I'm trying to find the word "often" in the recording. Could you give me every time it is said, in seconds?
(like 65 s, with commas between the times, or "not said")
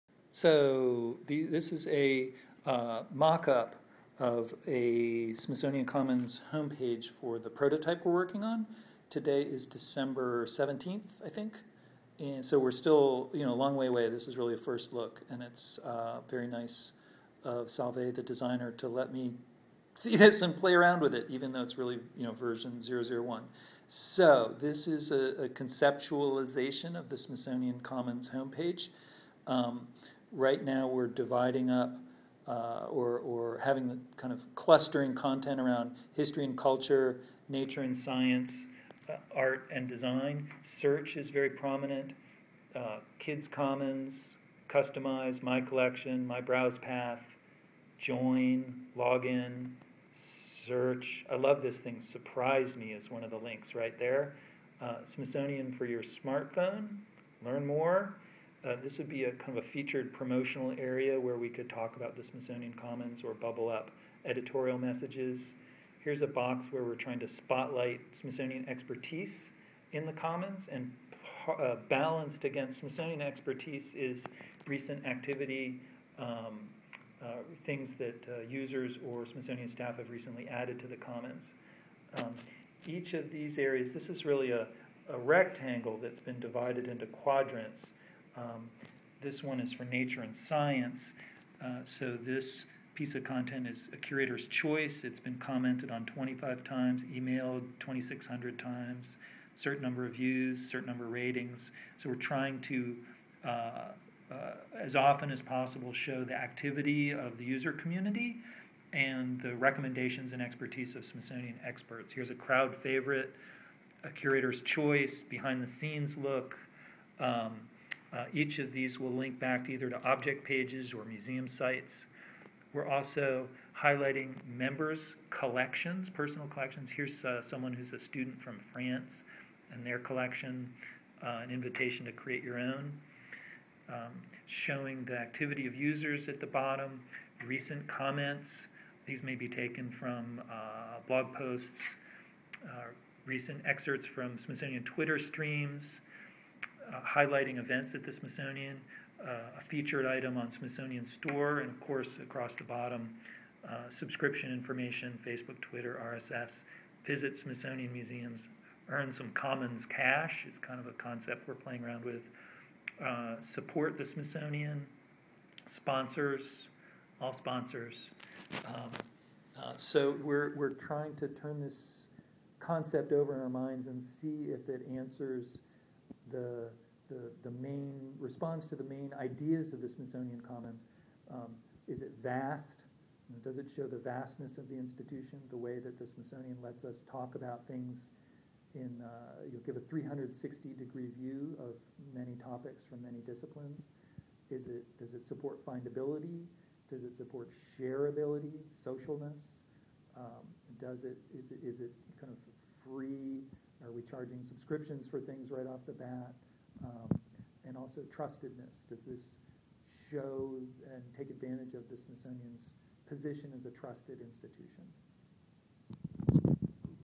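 104 s.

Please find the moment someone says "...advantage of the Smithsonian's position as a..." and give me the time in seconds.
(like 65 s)
211 s.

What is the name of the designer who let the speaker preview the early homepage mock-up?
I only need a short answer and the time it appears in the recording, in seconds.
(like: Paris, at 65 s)
Salve, at 17 s.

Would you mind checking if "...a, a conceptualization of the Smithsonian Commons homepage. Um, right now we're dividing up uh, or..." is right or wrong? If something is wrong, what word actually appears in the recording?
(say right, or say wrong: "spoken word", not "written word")
right.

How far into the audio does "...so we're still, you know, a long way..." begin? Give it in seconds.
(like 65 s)
12 s.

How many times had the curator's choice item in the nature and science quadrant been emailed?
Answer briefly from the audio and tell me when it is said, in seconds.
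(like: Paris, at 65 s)
2,600, at 97 s.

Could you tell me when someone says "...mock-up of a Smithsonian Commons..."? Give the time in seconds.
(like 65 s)
3 s.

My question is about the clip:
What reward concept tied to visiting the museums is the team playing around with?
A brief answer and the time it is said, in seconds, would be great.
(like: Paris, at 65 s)
Commons cash, at 159 s.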